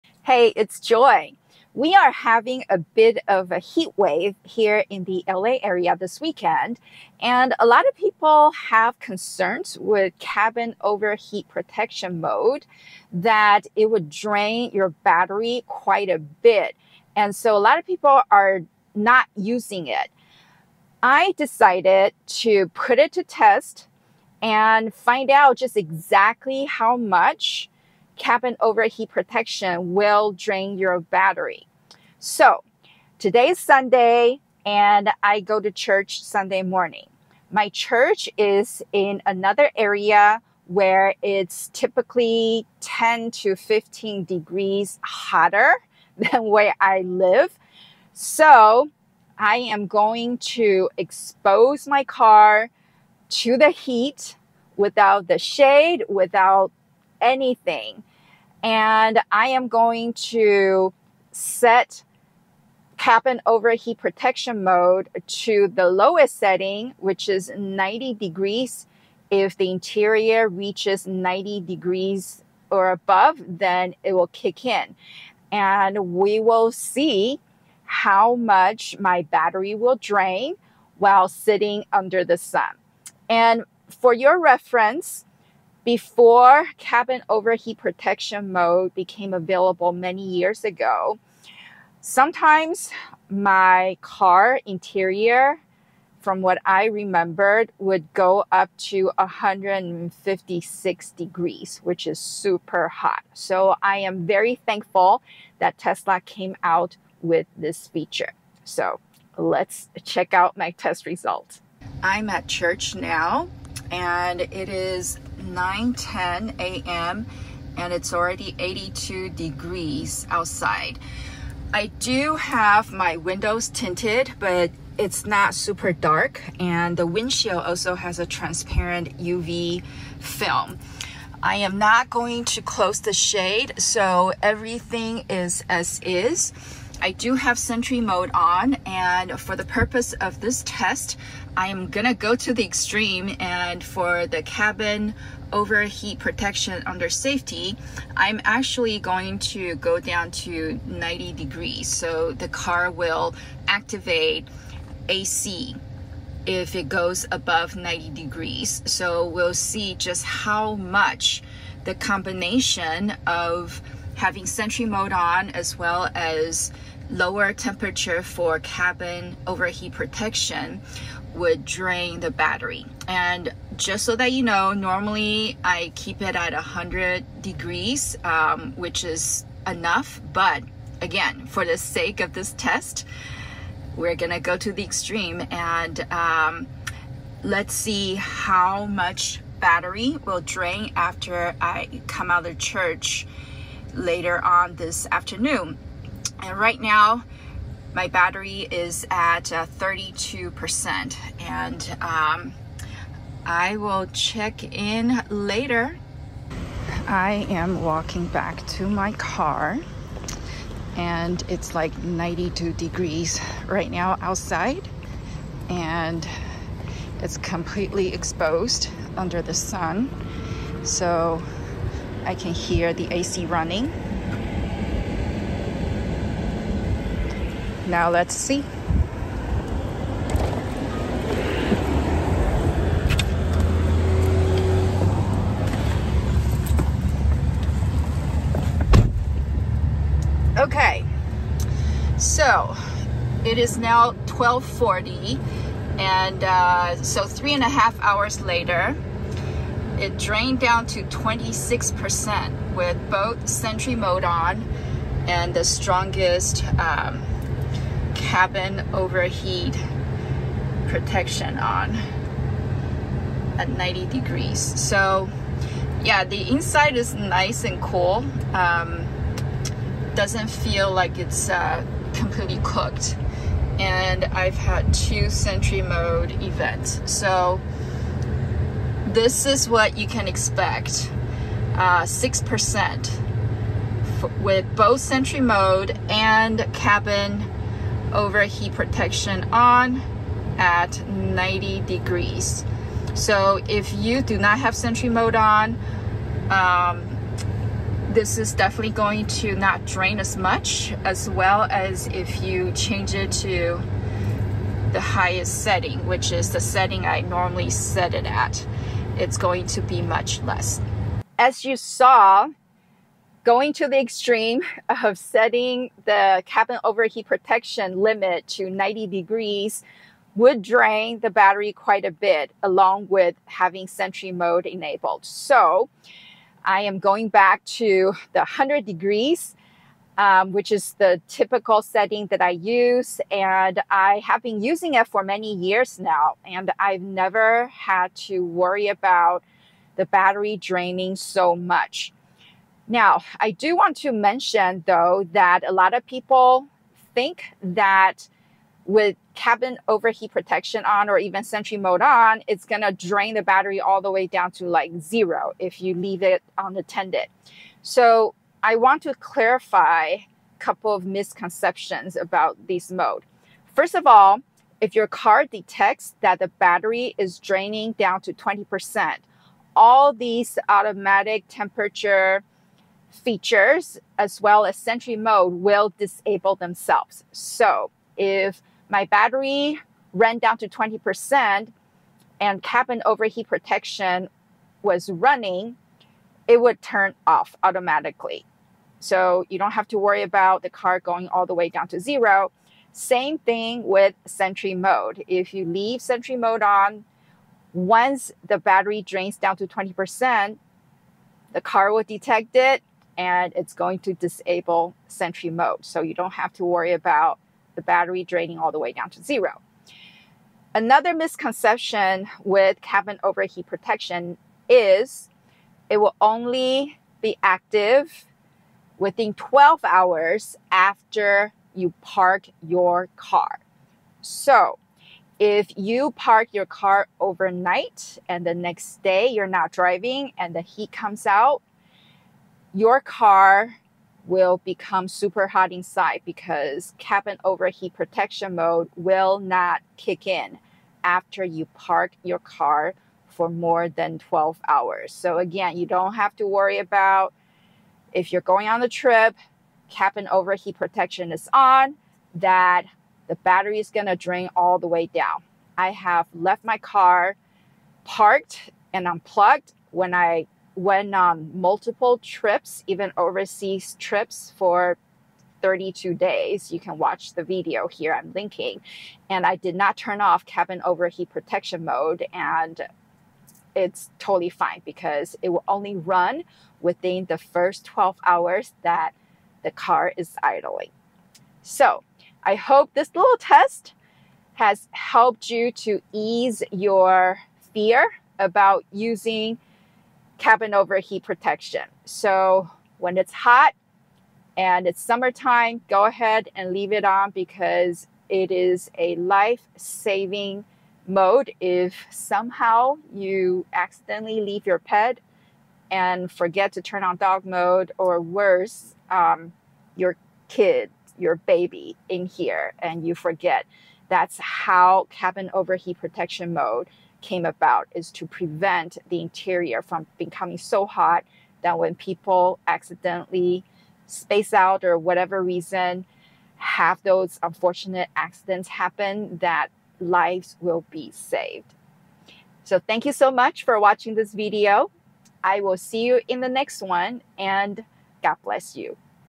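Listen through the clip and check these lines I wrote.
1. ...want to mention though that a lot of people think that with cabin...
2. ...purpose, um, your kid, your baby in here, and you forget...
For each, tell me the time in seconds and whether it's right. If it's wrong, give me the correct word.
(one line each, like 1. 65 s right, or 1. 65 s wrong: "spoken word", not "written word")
1. 343 s right
2. 508 s wrong: "worse", not "purpose".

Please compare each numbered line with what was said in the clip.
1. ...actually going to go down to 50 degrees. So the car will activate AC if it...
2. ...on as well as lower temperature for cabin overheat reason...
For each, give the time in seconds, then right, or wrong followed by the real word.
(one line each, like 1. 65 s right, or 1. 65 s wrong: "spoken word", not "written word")
1. 148 s wrong: "90", not "50"
2. 165 s wrong: "protection", not "reason".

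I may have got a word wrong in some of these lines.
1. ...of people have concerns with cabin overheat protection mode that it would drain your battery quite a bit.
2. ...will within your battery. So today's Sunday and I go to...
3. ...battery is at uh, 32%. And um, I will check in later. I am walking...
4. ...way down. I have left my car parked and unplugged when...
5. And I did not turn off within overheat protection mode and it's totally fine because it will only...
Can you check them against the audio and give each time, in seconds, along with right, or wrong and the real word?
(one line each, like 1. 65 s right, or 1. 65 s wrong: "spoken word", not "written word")
1. 7 s right
2. 29 s wrong: "drain", not "within"
3. 198 s right
4. 454 s right
5. 469 s wrong: "cabin", not "within".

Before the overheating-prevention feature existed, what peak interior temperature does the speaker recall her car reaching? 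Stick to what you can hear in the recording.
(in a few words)
156 degrees.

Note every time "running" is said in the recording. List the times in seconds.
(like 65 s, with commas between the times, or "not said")
223 s, 385 s.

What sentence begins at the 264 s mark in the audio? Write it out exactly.
So yeah, the inside is nice and cool.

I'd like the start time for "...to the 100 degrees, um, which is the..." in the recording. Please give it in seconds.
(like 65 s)
327 s.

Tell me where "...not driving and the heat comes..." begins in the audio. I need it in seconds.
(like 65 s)
429 s.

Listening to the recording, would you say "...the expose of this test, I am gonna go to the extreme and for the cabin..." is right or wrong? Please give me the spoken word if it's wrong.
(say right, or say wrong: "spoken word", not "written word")
wrong: "purpose", not "expose".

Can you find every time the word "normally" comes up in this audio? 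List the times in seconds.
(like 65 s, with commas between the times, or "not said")
174 s, 307 s.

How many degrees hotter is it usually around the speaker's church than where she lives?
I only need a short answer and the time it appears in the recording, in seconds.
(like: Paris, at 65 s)
10 to 15 degrees, at 42 s.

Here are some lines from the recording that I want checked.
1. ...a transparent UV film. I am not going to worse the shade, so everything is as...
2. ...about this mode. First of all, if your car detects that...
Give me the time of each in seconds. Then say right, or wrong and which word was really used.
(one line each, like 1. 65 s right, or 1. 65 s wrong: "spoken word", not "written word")
1. 128 s wrong: "close", not "worse"
2. 362 s right.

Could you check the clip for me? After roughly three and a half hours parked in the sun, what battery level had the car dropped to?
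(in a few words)
26%.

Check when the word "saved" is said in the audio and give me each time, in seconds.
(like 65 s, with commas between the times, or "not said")
531 s.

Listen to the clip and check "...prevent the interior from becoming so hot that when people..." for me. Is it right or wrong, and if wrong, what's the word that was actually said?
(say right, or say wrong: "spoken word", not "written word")
right.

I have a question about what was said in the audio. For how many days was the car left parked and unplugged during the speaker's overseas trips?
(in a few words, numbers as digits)
32 days.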